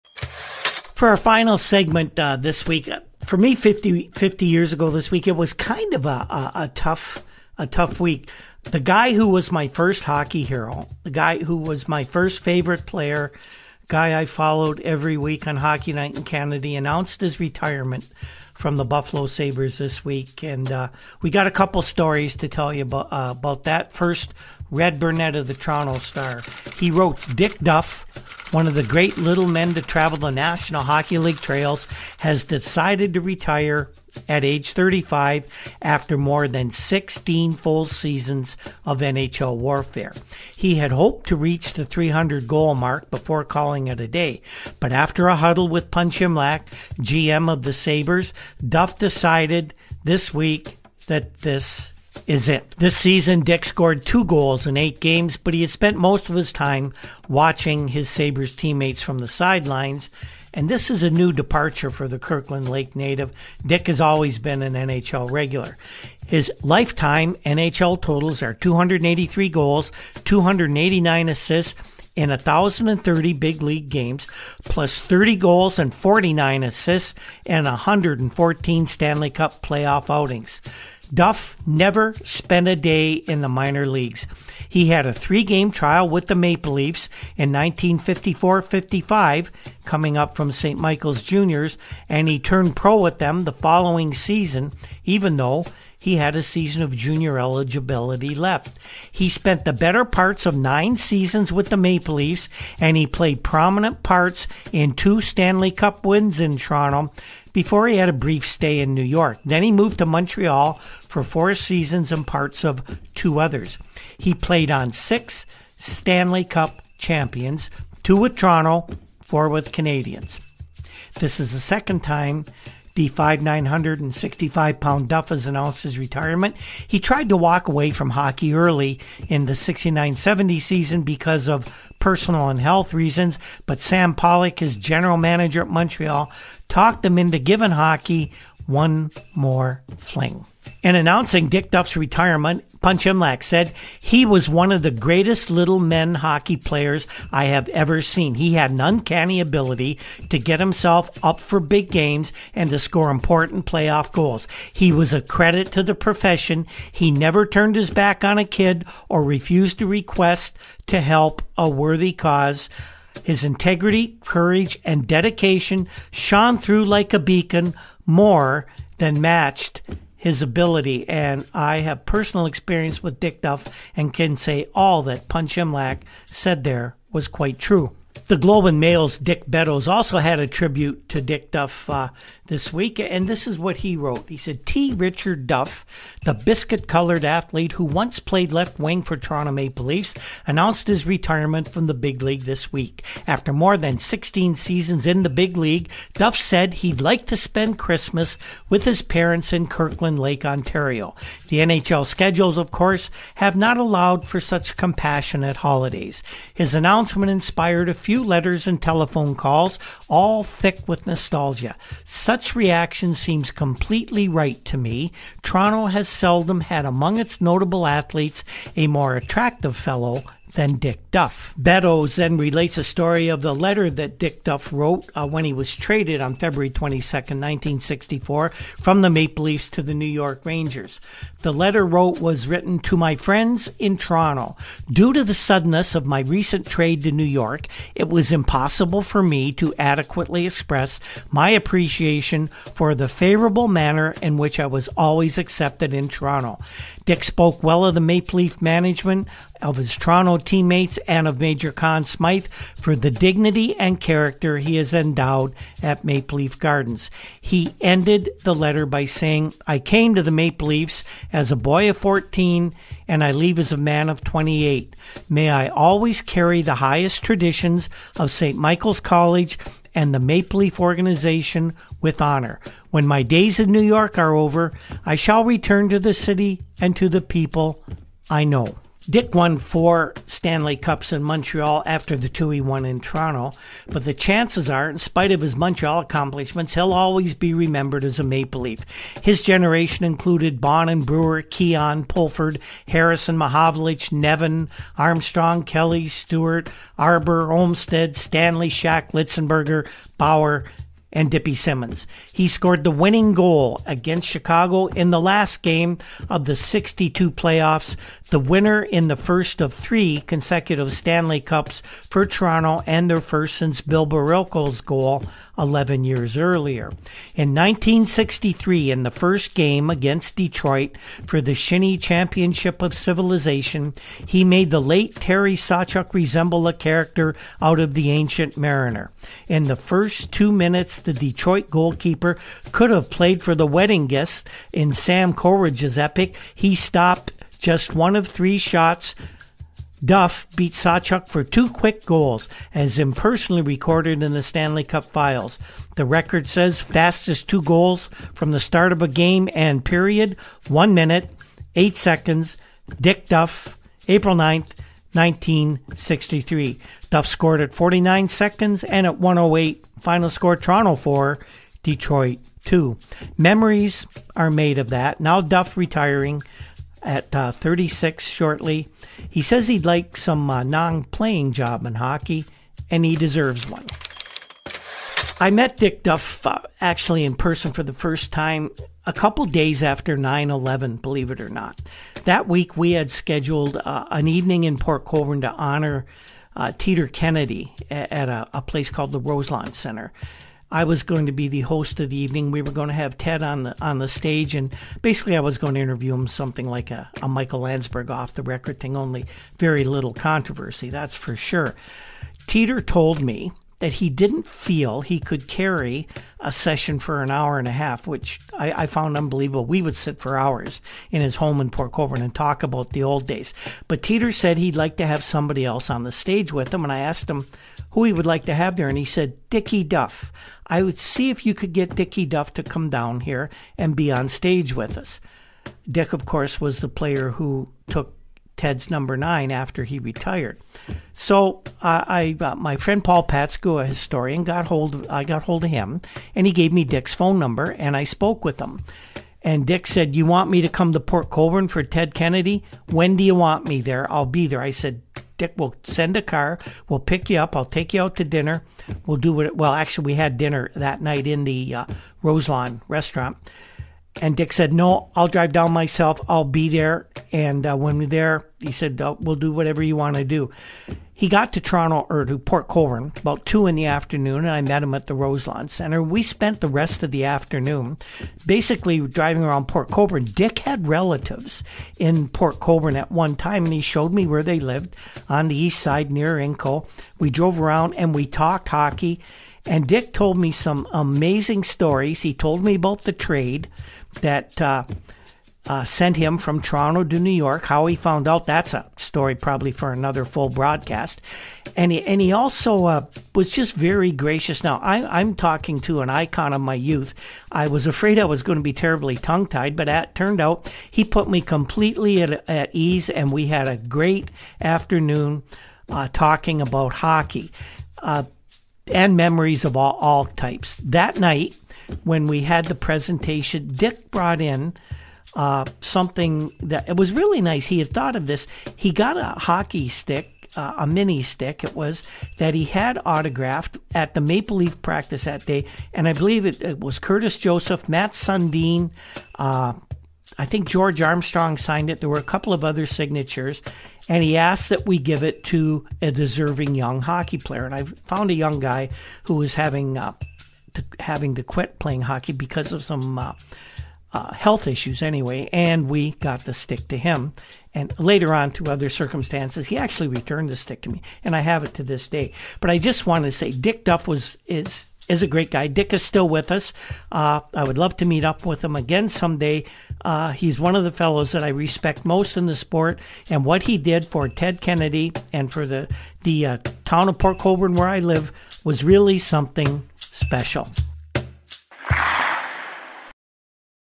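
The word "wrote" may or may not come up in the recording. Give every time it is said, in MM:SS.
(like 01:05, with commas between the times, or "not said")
00:26, 03:03, 03:44, 03:51.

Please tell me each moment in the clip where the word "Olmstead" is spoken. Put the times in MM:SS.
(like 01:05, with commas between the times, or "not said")
04:57.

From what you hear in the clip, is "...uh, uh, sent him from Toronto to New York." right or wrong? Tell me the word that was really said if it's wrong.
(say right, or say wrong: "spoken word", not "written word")
right.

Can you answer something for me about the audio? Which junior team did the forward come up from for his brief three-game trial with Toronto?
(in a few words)
St. Michael's Juniors.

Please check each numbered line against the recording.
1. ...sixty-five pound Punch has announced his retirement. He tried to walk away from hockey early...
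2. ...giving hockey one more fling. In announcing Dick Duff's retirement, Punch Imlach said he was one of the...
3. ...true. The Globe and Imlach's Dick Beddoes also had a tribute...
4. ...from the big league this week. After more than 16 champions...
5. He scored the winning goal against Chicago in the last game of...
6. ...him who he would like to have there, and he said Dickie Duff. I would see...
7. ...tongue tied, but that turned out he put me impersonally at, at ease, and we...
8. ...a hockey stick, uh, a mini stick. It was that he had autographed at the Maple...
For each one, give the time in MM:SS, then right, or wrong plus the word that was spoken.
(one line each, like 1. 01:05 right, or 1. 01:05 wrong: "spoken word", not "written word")
1. 02:04 wrong: "Duff", not "Punch"
2. 02:17 right
3. 02:57 wrong: "Mail", not "Imlach"
4. 03:11 wrong: "seasons", not "champions"
5. 05:02 right
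6. 06:57 right
7. 08:19 wrong: "completely", not "impersonally"
8. 08:39 right.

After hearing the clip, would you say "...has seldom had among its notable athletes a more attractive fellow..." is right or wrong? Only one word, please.
right.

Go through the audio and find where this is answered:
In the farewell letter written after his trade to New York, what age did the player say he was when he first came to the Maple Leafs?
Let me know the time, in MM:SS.
04:21.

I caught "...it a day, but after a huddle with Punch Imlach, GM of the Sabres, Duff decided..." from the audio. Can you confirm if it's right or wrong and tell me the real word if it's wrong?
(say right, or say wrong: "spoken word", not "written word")
right.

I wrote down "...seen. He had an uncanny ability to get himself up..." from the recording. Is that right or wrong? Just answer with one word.
right.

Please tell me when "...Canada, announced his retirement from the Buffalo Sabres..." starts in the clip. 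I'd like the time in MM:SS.
00:16.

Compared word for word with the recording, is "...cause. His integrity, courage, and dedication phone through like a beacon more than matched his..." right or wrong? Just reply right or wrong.
wrong.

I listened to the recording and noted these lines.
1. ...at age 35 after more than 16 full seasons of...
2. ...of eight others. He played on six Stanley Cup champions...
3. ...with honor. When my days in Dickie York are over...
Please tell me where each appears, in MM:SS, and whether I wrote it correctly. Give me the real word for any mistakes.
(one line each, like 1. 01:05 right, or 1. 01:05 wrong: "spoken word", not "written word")
1. 00:34 right
2. 01:52 wrong: "two", not "eight"
3. 04:31 wrong: "New", not "Dickie".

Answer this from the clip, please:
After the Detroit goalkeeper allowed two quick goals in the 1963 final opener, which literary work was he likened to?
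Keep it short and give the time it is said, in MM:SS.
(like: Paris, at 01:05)
The Ancient Mariner, at 05:27.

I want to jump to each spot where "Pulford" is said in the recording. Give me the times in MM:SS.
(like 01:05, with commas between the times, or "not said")
04:52.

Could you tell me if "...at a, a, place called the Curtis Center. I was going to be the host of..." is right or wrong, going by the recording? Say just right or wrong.
wrong.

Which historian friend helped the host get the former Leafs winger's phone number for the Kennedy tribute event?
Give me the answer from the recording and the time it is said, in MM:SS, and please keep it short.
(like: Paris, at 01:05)
Paul Patskou, at 07:13.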